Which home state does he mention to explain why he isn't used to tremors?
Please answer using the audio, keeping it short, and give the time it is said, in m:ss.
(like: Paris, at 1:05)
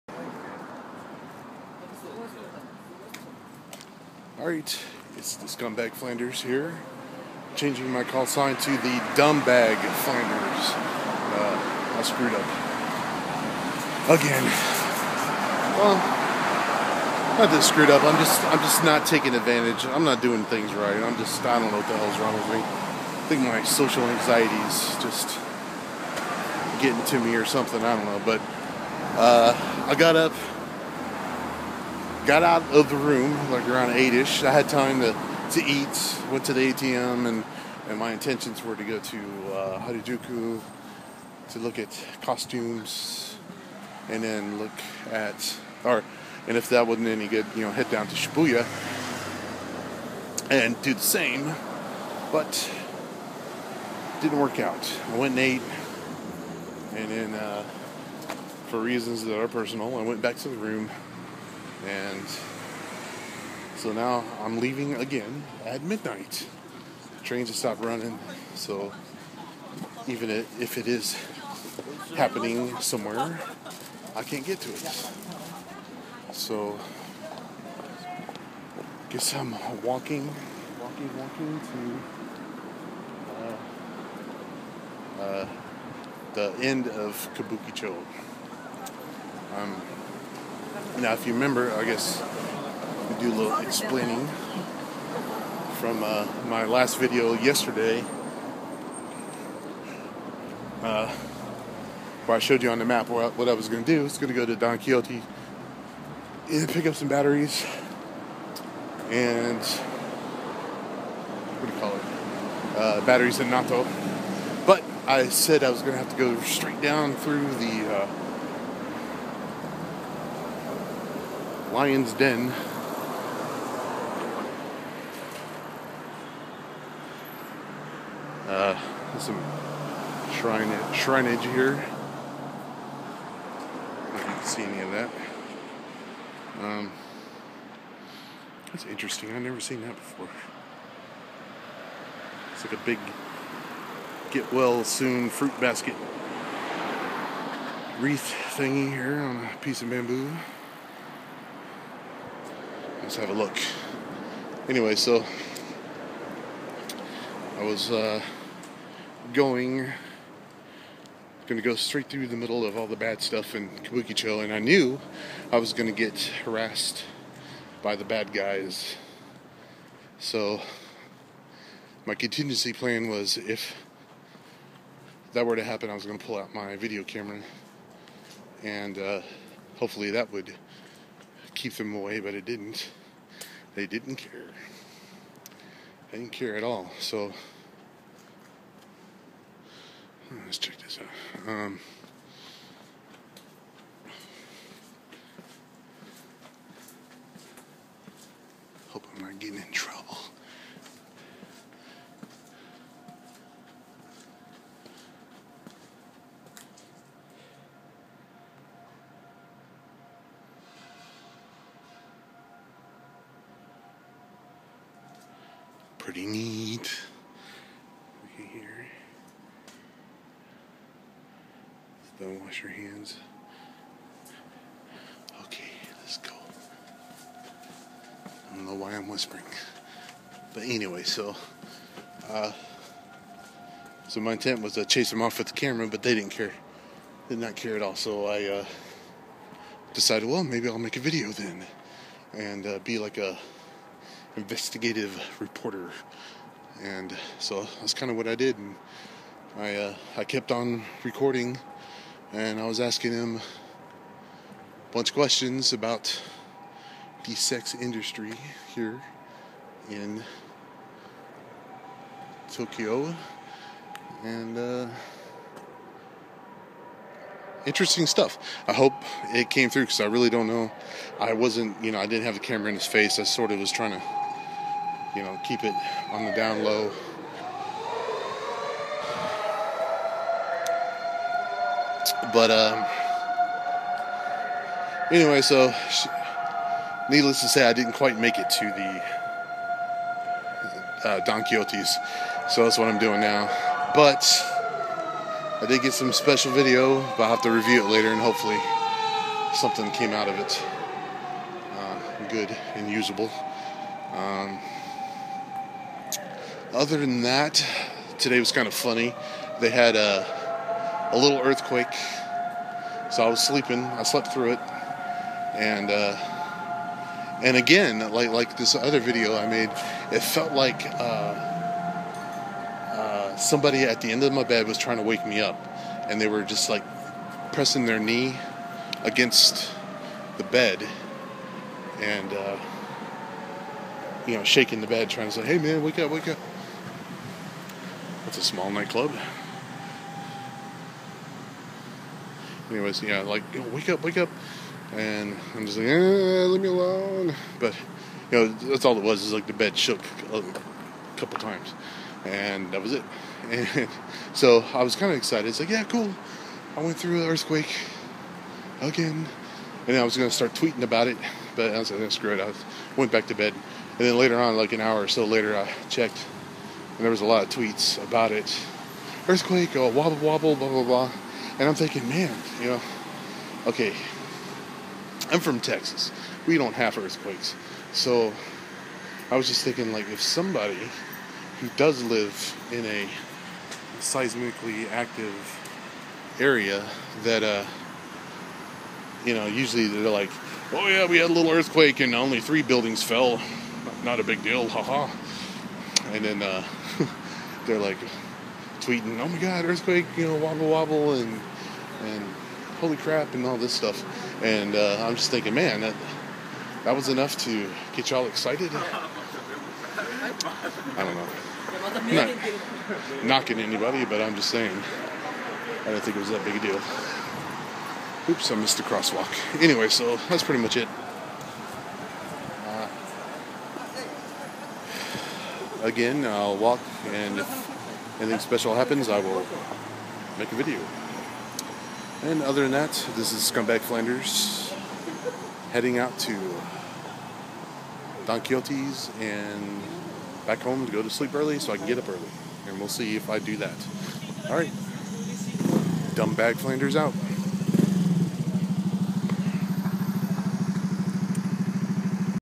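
Texas, at 6:15.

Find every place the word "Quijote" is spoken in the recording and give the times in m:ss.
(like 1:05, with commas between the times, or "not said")
1:44, 4:51, 7:18.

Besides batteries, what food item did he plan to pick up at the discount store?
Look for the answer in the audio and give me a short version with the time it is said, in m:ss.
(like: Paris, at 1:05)
Natto, at 1:53.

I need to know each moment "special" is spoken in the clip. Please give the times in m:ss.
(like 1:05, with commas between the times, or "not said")
4:56, 7:08.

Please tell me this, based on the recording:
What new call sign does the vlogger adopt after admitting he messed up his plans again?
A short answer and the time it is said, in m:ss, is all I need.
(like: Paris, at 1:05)
Dumbbag Flanders, at 0:09.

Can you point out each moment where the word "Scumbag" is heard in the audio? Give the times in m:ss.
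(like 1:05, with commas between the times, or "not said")
0:05, 7:13.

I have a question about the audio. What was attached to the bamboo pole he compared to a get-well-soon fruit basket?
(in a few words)
wreath.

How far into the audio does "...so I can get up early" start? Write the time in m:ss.
7:21.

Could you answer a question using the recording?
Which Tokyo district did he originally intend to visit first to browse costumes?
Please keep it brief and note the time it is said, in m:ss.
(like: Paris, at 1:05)
Harajuku, at 0:39.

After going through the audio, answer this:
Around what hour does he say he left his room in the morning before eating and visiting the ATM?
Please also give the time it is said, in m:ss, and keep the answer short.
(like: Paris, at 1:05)
8, at 0:33.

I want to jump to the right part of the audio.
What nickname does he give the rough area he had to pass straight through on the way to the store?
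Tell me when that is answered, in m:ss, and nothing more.
2:01.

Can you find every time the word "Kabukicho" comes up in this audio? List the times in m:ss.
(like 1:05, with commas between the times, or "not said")
1:27, 2:43.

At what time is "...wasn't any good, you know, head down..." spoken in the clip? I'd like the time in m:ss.
0:46.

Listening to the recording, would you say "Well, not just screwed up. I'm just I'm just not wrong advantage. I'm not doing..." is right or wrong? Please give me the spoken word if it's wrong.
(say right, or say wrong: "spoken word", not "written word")
wrong: "taking", not "wrong".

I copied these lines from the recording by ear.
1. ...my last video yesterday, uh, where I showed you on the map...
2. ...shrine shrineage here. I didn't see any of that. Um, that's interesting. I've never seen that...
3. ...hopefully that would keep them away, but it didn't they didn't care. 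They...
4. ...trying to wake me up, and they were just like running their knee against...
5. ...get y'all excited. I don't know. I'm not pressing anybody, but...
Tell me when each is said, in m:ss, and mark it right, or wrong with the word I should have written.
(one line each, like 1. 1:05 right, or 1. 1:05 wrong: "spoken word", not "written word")
1. 1:36 right
2. 2:10 right
3. 2:59 right
4. 5:24 wrong: "pressing", not "running"
5. 6:47 wrong: "knocking", not "pressing".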